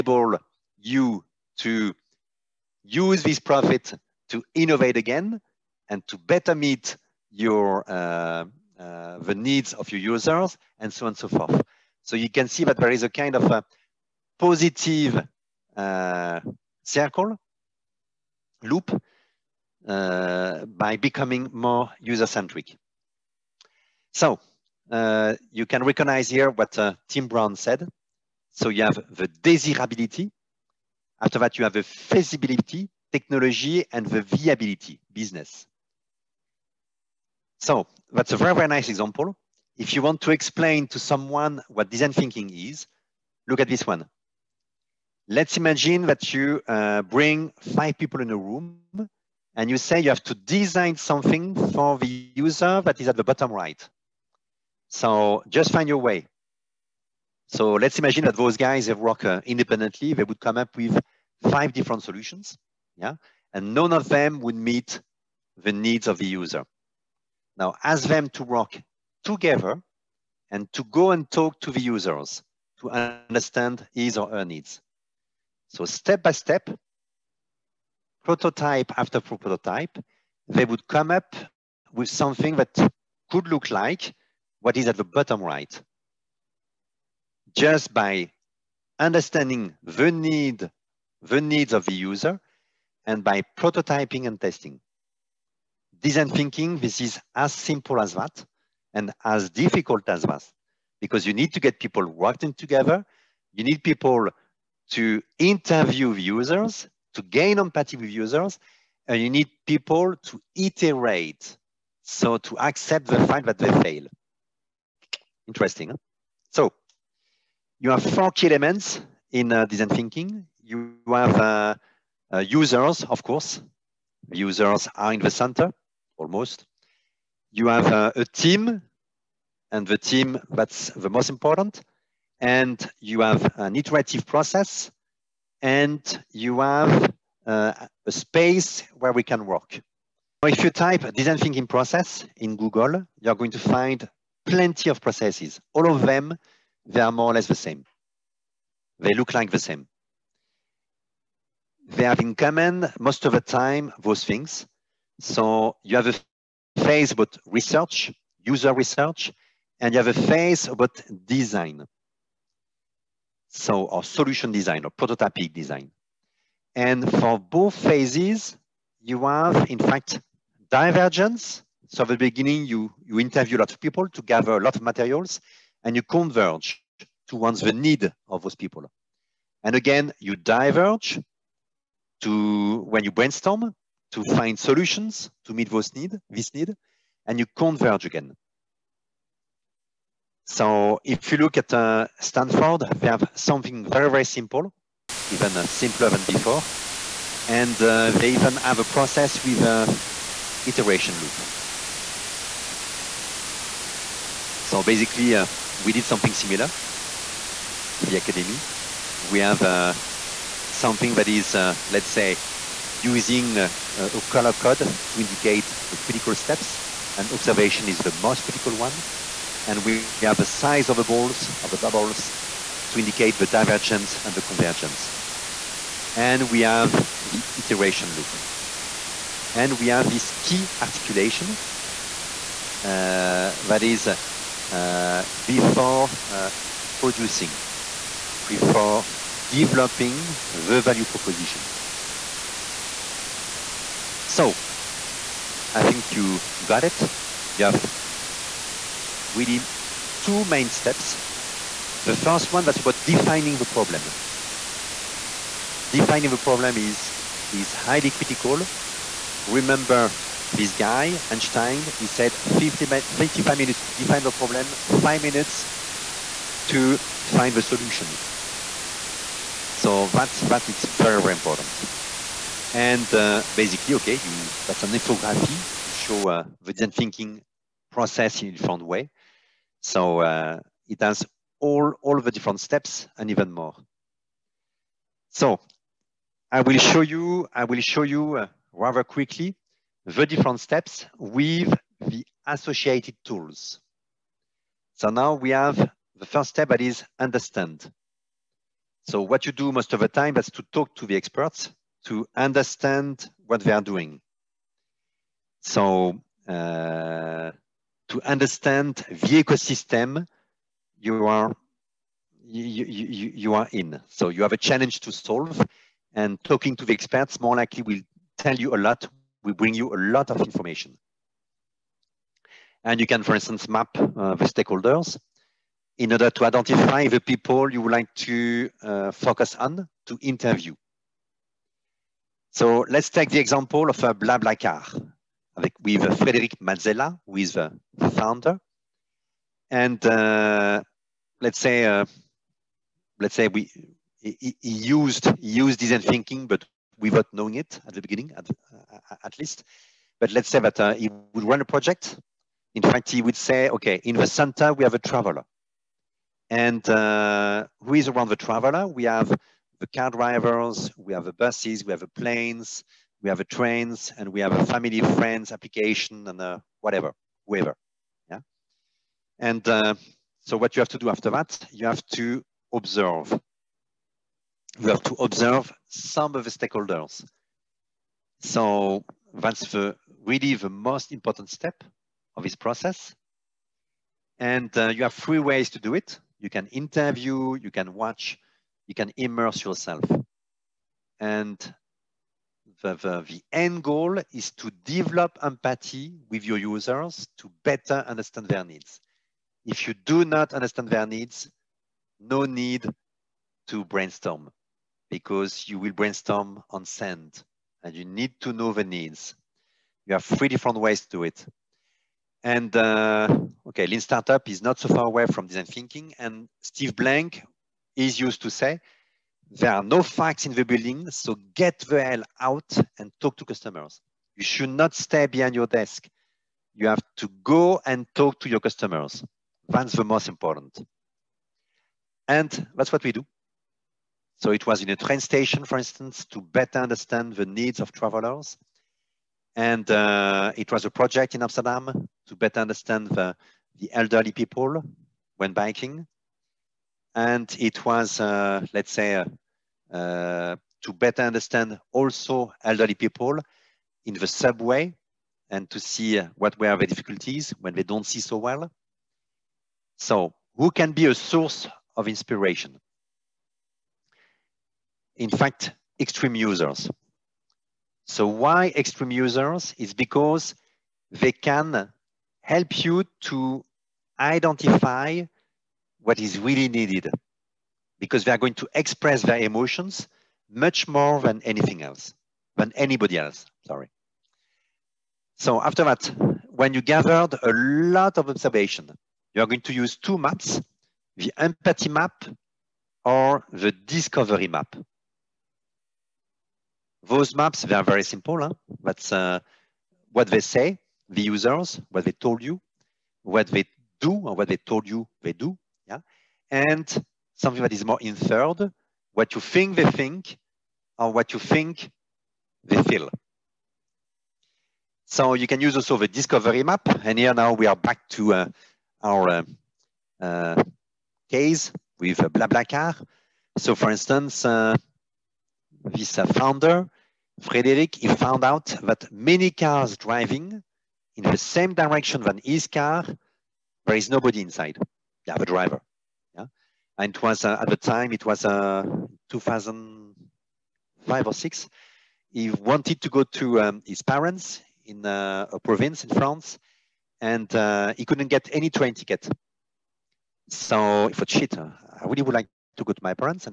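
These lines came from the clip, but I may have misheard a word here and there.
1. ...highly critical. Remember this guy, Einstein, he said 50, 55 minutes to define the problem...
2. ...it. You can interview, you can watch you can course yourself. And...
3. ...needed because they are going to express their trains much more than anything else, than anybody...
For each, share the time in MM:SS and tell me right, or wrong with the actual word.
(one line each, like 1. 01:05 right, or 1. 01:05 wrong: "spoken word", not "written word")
1. 04:17 right
2. 06:25 wrong: "immerse", not "course"
3. 07:56 wrong: "emotions", not "trains".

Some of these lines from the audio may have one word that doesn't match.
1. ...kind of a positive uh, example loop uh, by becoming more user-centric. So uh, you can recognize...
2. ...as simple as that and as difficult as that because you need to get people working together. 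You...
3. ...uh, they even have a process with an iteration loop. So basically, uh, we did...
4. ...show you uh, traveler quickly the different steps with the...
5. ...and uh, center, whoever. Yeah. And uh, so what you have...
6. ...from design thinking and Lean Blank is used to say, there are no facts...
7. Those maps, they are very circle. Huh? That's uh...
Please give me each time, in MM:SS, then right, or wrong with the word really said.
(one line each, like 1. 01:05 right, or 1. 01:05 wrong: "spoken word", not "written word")
1. 00:13 wrong: "circle", not "example"
2. 01:37 right
3. 03:17 right
4. 04:47 wrong: "rather", not "traveler"
5. 06:06 wrong: "whatever", not "center"
6. 06:55 wrong: "Steve", not "Lean"
7. 08:17 wrong: "simple", not "circle".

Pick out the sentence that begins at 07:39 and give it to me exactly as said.
So who can be a source of inspiration?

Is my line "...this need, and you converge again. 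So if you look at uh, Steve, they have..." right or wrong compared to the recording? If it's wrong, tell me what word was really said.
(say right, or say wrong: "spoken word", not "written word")
wrong: "Stanford", not "Steve".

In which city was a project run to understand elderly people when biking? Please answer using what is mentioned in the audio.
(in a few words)
Amsterdam.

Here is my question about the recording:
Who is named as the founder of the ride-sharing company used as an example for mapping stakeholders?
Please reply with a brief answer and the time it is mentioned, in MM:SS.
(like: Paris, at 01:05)
Frederic Mazzella, at 05:36.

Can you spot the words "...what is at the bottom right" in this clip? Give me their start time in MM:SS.
01:24.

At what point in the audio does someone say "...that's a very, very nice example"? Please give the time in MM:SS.
00:38.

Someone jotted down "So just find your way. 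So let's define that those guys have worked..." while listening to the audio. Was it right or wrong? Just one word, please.
wrong.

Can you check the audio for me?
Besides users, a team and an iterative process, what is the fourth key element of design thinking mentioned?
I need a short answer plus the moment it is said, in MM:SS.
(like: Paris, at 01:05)
A space, at 02:18.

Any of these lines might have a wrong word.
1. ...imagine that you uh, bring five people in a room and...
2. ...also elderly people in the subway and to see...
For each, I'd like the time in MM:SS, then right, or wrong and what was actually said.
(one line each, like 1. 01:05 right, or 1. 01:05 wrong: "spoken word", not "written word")
1. 00:45 right
2. 07:31 right.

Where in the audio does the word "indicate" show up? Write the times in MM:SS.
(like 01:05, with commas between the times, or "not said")
03:35, 03:42.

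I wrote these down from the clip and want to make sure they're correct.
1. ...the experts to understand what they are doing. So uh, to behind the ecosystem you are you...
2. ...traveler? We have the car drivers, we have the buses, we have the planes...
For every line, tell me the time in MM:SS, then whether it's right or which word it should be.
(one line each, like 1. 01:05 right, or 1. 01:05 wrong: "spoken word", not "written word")
1. 05:01 wrong: "understand", not "behind"
2. 05:58 right.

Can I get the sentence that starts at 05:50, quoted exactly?
But let's say that uh, he would run a project.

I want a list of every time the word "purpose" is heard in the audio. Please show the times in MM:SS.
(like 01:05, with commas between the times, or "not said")
not said.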